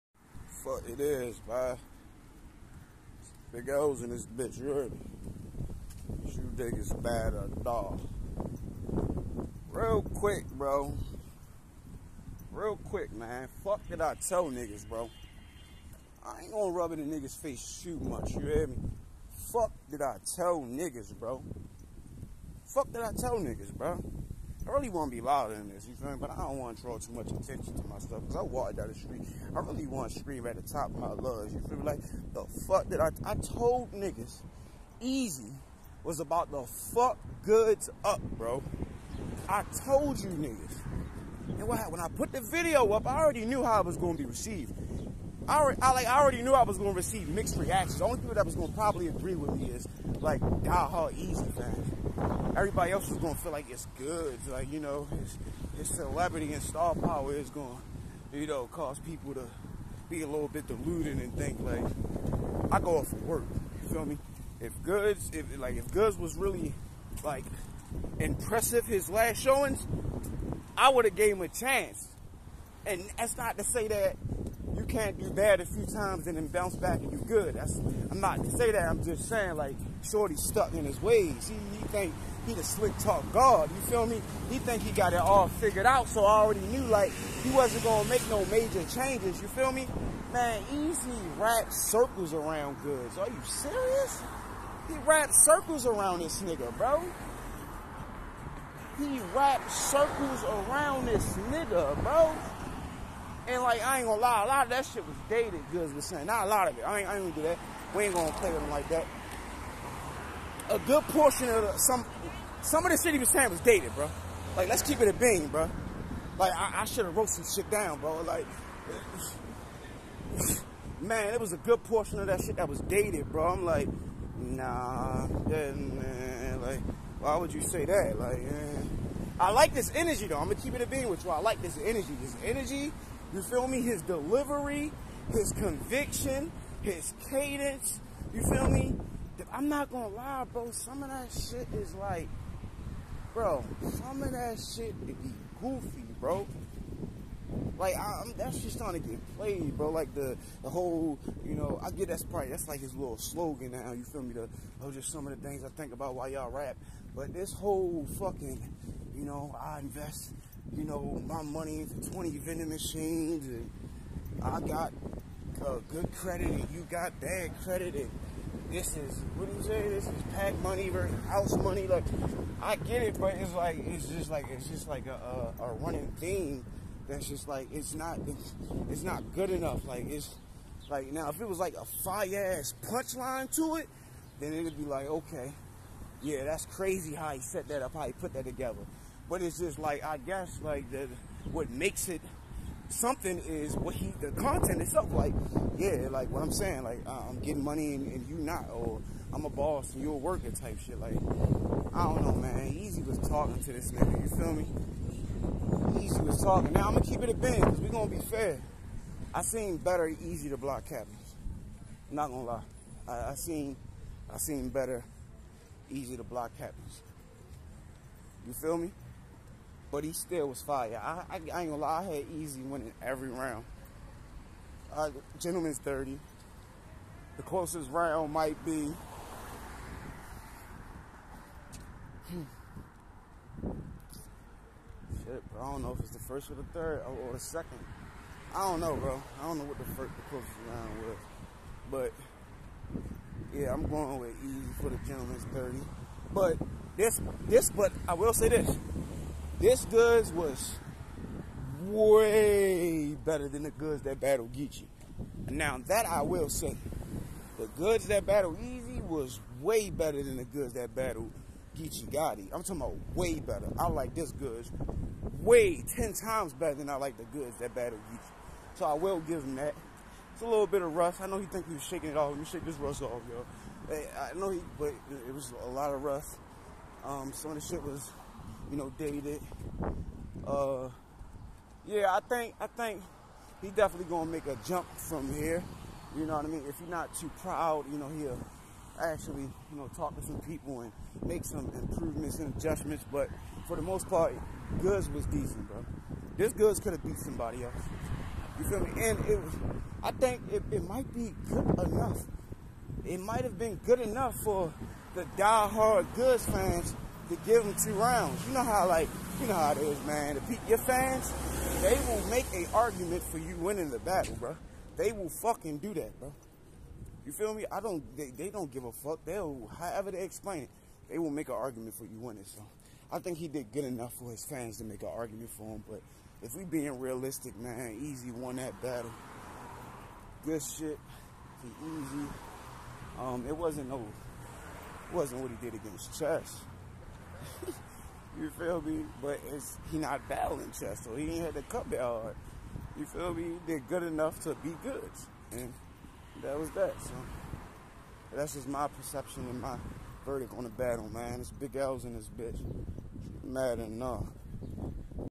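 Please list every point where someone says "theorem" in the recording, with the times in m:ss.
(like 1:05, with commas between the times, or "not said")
not said.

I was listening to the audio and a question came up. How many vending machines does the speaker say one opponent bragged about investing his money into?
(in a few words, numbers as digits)
20.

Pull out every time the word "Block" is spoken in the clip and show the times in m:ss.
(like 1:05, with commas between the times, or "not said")
3:30, 3:36.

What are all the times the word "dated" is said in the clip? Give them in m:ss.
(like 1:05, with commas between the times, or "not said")
1:45, 1:53, 2:02, 4:38.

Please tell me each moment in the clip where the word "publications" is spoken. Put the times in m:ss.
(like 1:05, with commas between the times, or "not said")
not said.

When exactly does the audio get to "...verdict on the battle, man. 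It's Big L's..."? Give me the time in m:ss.
5:50.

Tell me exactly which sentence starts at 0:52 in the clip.
Everybody else was going to feel like it's good.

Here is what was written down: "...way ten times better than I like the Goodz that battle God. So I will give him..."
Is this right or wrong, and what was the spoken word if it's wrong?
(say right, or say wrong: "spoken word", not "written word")
wrong: "Geechee", not "God".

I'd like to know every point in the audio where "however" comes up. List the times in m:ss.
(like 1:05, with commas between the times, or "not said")
5:19.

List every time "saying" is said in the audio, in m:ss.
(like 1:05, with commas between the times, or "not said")
1:19, 1:46, 1:53, 3:16.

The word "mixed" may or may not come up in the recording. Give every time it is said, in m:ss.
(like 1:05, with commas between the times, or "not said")
0:47.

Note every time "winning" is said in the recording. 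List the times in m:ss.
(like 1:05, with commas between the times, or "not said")
3:42, 5:13, 5:22.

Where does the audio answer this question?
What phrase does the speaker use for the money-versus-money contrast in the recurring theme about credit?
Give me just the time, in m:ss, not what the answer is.
2:50.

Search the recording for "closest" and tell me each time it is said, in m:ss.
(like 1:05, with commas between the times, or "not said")
3:47, 4:00.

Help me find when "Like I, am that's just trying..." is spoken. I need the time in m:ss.
2:27.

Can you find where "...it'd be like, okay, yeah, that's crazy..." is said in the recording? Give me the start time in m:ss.
3:04.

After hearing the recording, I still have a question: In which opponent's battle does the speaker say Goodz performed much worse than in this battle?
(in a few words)
Geechee Gotti.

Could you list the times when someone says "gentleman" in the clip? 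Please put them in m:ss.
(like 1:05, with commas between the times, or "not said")
3:45, 4:05.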